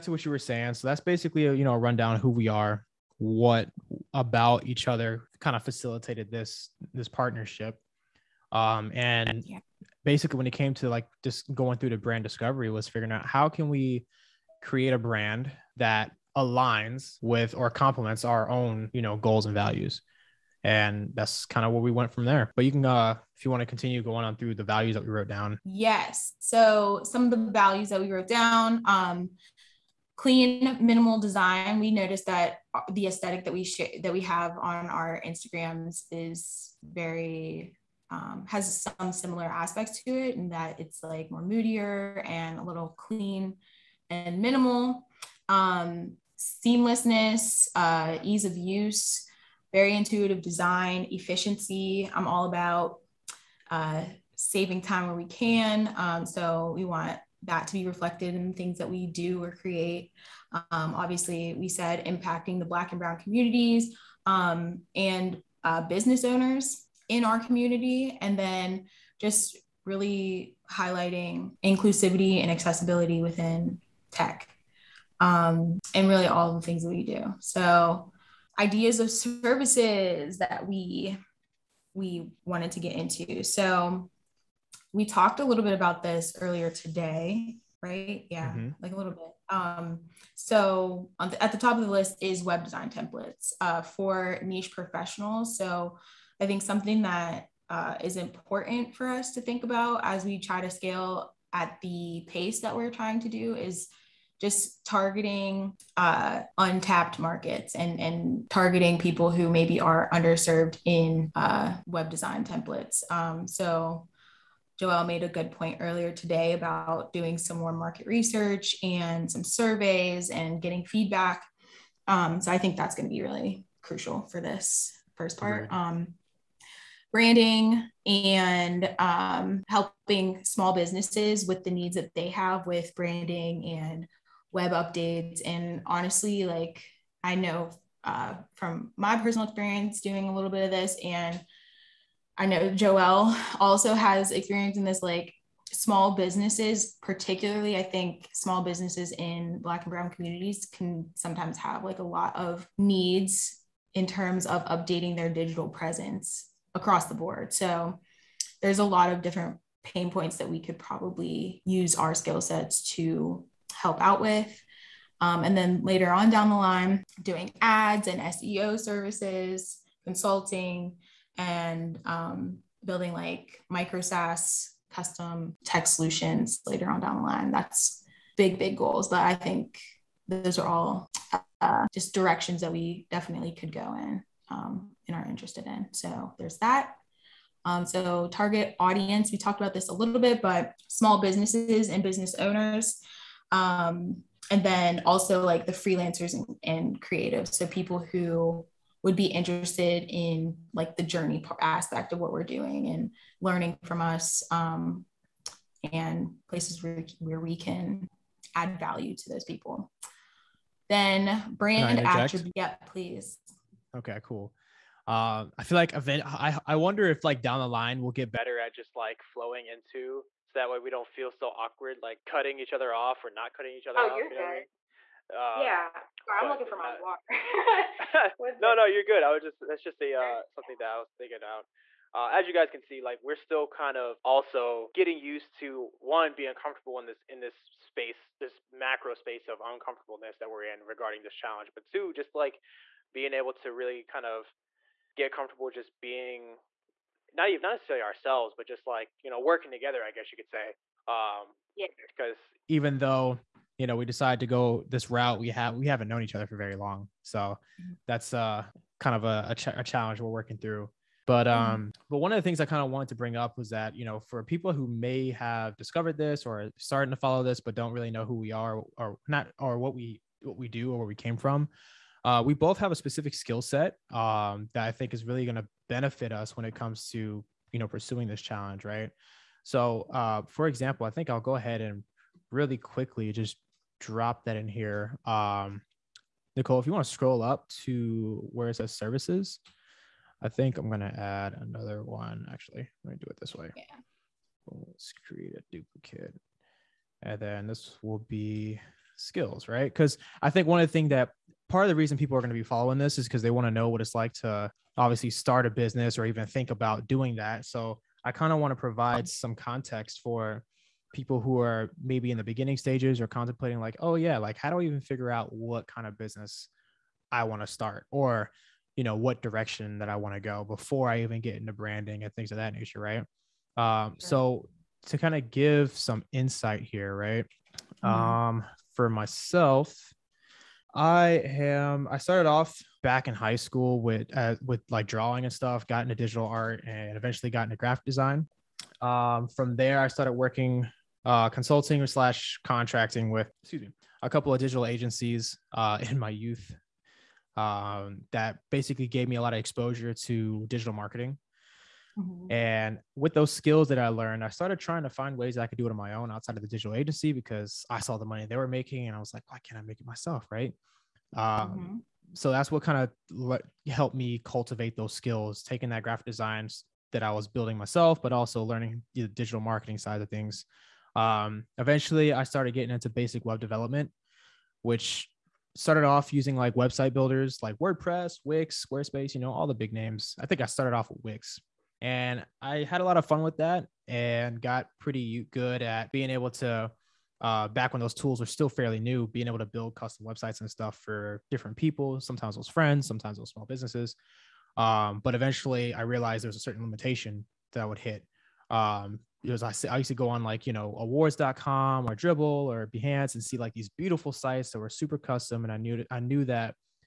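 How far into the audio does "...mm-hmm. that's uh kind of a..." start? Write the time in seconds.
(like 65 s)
257 s.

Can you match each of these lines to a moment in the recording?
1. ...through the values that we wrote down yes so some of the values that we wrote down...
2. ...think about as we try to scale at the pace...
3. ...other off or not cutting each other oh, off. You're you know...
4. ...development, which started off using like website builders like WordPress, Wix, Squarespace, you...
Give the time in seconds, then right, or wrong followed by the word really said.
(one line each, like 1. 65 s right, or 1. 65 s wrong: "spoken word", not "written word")
1. 24 s right
2. 99 s right
3. 222 s right
4. 373 s right.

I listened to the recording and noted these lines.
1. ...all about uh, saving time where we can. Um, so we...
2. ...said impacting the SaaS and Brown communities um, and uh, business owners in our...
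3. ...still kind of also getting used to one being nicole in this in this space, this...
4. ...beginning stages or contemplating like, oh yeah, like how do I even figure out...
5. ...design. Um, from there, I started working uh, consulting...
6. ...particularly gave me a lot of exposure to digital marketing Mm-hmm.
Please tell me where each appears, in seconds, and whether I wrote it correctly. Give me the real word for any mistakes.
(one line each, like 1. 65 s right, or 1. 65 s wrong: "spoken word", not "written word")
1. 52 s right
2. 61 s wrong: "Black", not "SaaS"
3. 233 s wrong: "comfortable", not "nicole"
4. 312 s right
5. 338 s right
6. 348 s wrong: "basically", not "particularly".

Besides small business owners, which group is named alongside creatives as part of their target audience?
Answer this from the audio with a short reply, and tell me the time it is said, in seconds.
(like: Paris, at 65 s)
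Freelancers, at 195 s.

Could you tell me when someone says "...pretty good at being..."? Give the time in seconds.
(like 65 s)
384 s.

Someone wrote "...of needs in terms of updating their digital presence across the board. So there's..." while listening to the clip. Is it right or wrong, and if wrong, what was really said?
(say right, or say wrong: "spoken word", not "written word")
right.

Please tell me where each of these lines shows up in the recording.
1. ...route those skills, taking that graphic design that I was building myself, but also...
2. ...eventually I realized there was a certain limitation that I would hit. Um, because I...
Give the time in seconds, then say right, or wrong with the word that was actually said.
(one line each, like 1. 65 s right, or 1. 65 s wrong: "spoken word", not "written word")
1. 364 s wrong: "cultivate", not "route"
2. 395 s right.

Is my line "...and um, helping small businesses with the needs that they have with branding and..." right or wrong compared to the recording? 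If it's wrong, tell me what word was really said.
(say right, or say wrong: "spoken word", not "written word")
right.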